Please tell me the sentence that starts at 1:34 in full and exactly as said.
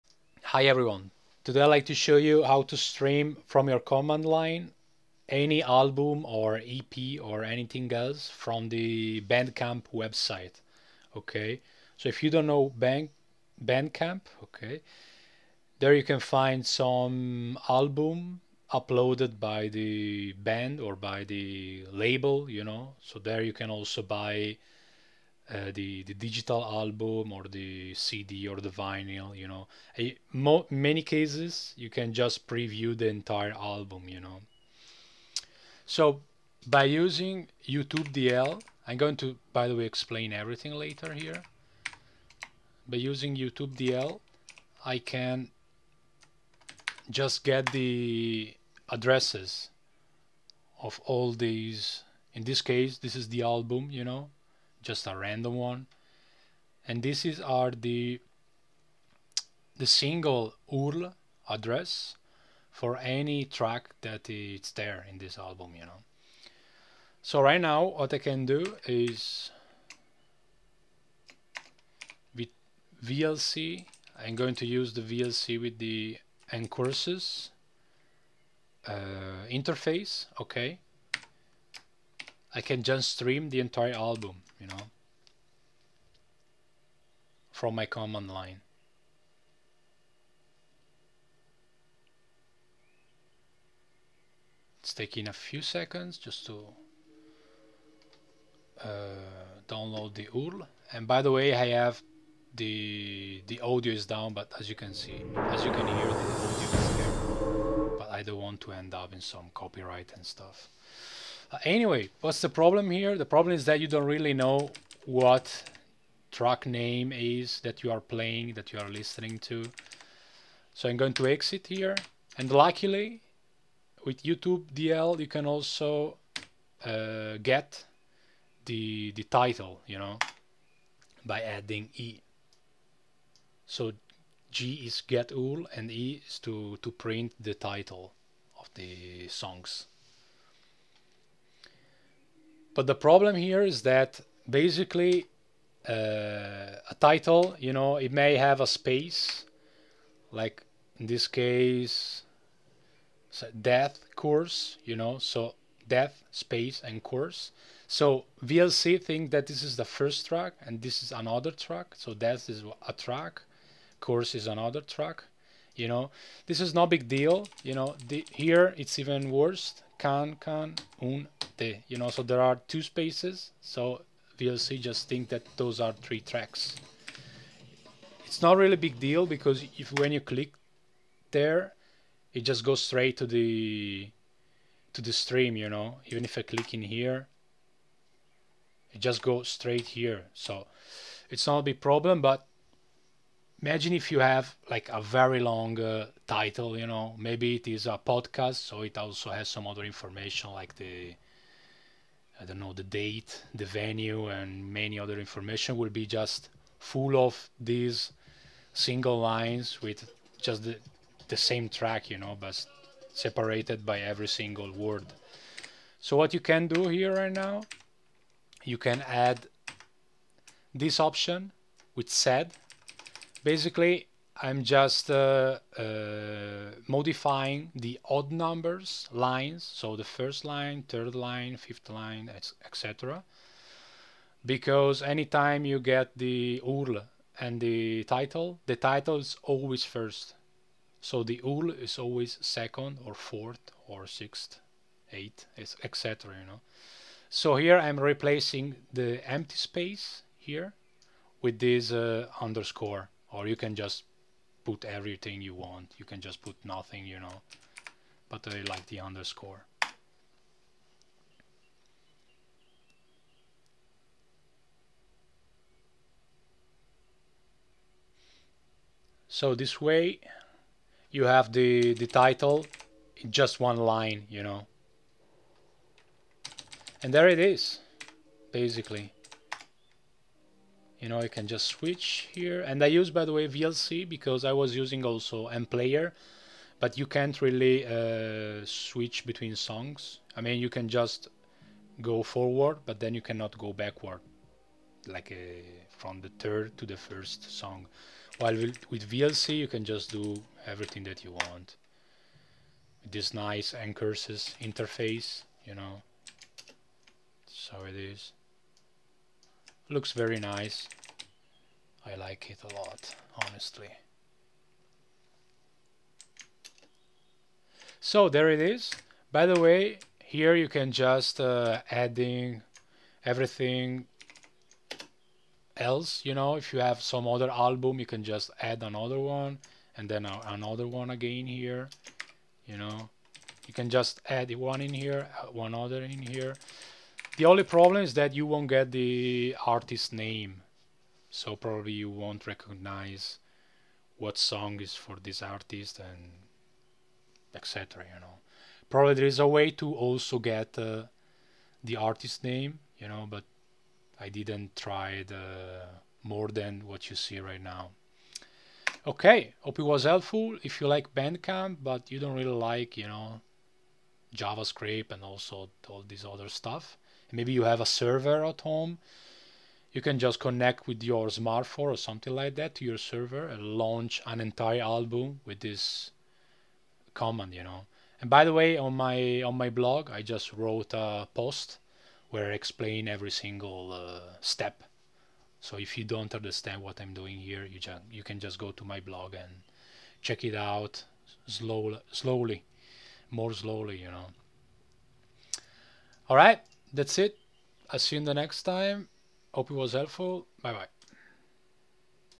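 It's taking a few seconds just to uh, download the URL.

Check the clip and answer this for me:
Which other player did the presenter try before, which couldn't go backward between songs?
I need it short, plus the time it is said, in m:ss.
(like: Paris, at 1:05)
mPlayer, at 4:45.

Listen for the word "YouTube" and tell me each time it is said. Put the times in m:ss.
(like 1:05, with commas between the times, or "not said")
0:37, 0:43, 2:04.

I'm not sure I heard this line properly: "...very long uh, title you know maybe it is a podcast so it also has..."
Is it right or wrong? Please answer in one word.
right.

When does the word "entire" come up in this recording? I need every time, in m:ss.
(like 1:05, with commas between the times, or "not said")
0:33, 1:23, 6:14.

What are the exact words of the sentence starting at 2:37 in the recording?
So VLC think that this is the first track and this is another track.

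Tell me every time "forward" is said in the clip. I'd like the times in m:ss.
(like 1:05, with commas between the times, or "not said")
4:52.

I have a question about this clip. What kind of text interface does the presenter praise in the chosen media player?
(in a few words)
ncurses.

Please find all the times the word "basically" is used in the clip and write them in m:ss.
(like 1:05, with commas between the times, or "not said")
2:24, 3:43, 4:38.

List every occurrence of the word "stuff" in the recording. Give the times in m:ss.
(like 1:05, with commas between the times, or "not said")
1:50, 6:06.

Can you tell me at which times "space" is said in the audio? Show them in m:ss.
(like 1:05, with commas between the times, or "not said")
2:28, 2:36, 2:52, 4:09.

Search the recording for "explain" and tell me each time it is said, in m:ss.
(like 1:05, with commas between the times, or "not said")
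0:39, 6:22.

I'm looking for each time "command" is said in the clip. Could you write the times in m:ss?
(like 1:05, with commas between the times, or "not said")
0:03, 1:27, 6:17.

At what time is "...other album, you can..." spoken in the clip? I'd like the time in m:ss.
5:27.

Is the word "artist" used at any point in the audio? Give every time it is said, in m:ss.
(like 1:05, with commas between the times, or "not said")
5:39, 5:45, 5:51.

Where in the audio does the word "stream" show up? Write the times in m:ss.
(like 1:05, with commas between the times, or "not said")
0:02, 1:23, 3:05.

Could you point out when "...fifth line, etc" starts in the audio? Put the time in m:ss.
3:51.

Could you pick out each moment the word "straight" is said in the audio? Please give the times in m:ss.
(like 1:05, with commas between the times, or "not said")
3:02, 3:09.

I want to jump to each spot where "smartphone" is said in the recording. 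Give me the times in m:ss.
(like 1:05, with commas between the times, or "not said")
6:11.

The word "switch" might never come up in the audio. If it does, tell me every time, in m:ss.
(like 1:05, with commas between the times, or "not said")
4:41, 4:48.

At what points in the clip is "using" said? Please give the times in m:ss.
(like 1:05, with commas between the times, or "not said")
0:36, 0:42, 4:44.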